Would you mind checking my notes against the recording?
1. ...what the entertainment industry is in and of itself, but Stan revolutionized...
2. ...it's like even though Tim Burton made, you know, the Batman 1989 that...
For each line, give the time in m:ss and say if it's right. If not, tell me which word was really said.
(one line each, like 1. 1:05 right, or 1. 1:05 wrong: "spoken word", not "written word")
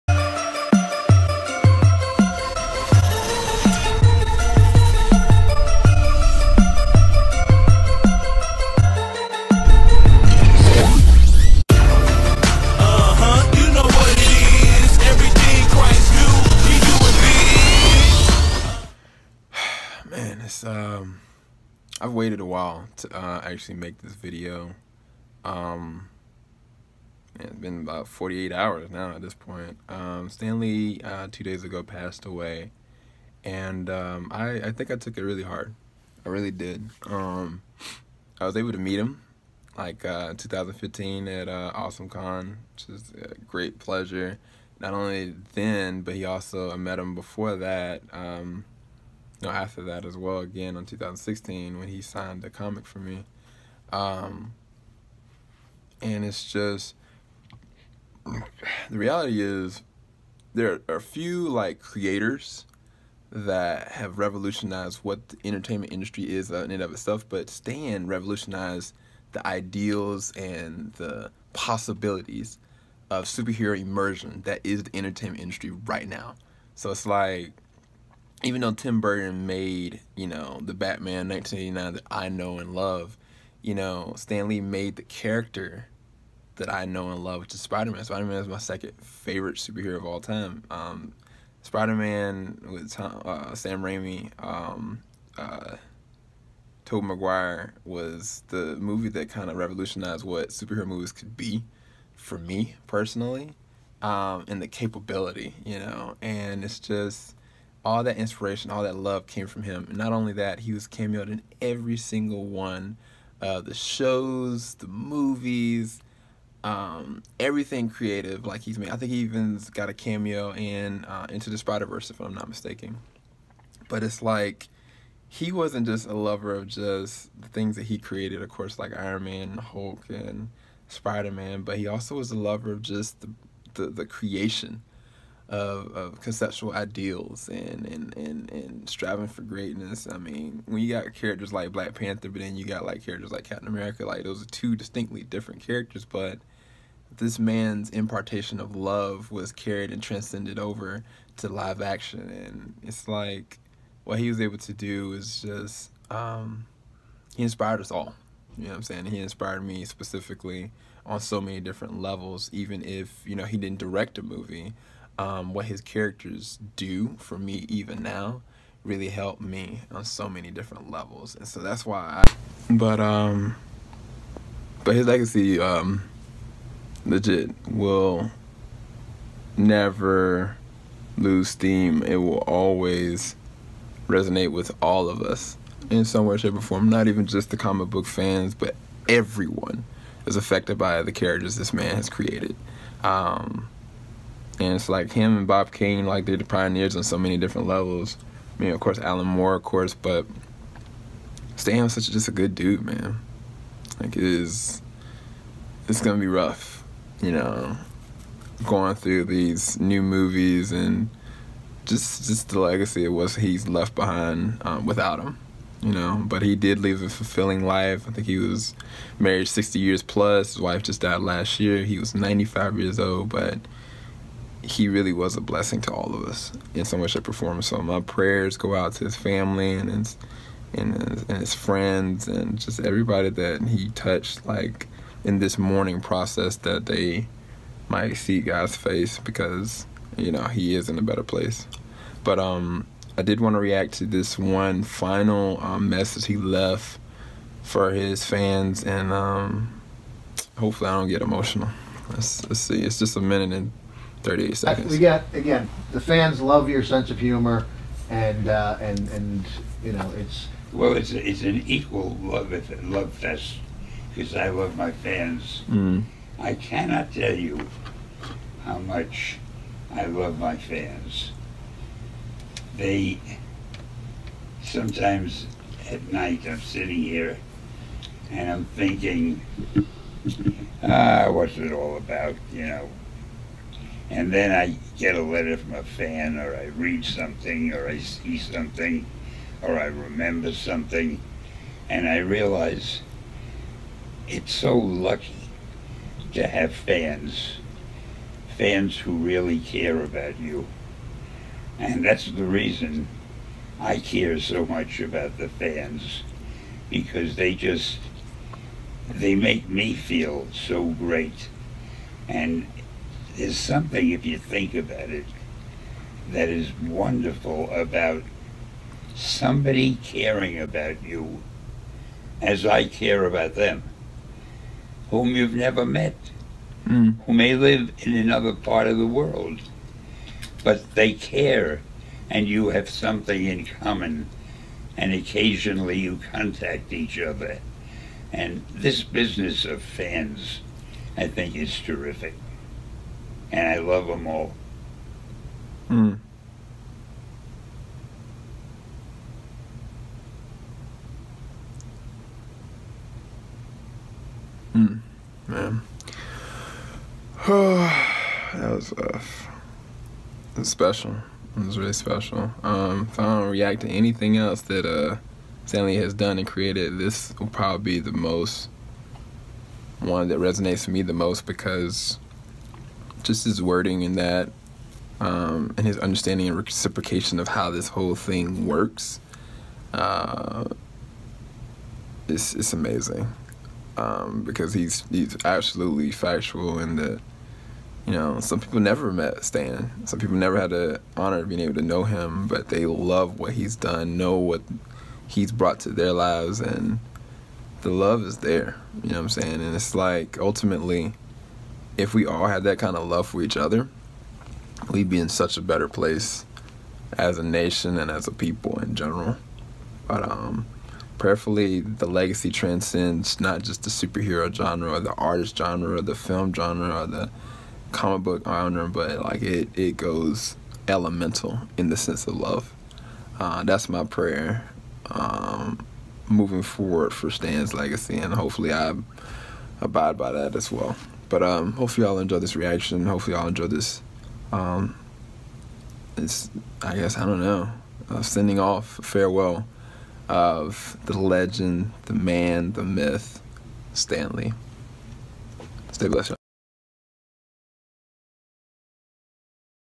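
1. 1:04 right
2. 1:16 right.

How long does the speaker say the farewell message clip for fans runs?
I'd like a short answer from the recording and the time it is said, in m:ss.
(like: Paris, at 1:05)
a minute and 30 seconds, at 4:13.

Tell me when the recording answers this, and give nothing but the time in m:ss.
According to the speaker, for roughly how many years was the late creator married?
3:39.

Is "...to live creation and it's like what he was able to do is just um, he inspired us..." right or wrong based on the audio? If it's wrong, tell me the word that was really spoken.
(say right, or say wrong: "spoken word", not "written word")
wrong: "action", not "creation".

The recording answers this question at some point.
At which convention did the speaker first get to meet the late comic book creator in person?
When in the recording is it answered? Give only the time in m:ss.
0:41.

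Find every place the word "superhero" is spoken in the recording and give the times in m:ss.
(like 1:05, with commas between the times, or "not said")
1:13, 1:29, 1:40, 6:53.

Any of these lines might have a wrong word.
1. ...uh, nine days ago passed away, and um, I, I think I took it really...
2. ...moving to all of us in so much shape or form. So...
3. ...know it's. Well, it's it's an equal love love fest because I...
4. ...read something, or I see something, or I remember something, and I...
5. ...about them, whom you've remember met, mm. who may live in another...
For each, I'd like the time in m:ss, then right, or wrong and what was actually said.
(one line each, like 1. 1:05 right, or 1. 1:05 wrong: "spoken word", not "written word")
1. 0:31 wrong: "two", not "nine"
2. 3:45 wrong: "blessing", not "moving"
3. 4:19 right
4. 4:46 right
5. 5:23 wrong: "never", not "remember".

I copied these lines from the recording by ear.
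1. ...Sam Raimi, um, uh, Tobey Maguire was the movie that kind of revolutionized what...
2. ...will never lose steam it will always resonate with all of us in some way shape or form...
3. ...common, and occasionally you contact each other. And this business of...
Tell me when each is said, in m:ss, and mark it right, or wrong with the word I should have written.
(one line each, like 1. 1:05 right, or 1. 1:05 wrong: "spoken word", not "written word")
1. 1:33 right
2. 2:57 right
3. 5:33 right.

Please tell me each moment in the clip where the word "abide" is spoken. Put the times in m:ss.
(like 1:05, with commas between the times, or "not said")
7:09.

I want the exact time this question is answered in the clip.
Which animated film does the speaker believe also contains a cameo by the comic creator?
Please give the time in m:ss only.
2:01.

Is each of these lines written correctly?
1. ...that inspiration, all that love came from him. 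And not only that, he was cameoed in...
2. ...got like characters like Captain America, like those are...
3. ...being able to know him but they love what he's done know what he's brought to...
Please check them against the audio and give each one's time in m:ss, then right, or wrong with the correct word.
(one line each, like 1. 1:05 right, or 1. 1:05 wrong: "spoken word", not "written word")
1. 1:48 right
2. 2:22 right
3. 6:31 right.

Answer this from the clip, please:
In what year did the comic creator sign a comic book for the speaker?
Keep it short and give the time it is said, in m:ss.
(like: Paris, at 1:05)
2016, at 0:50.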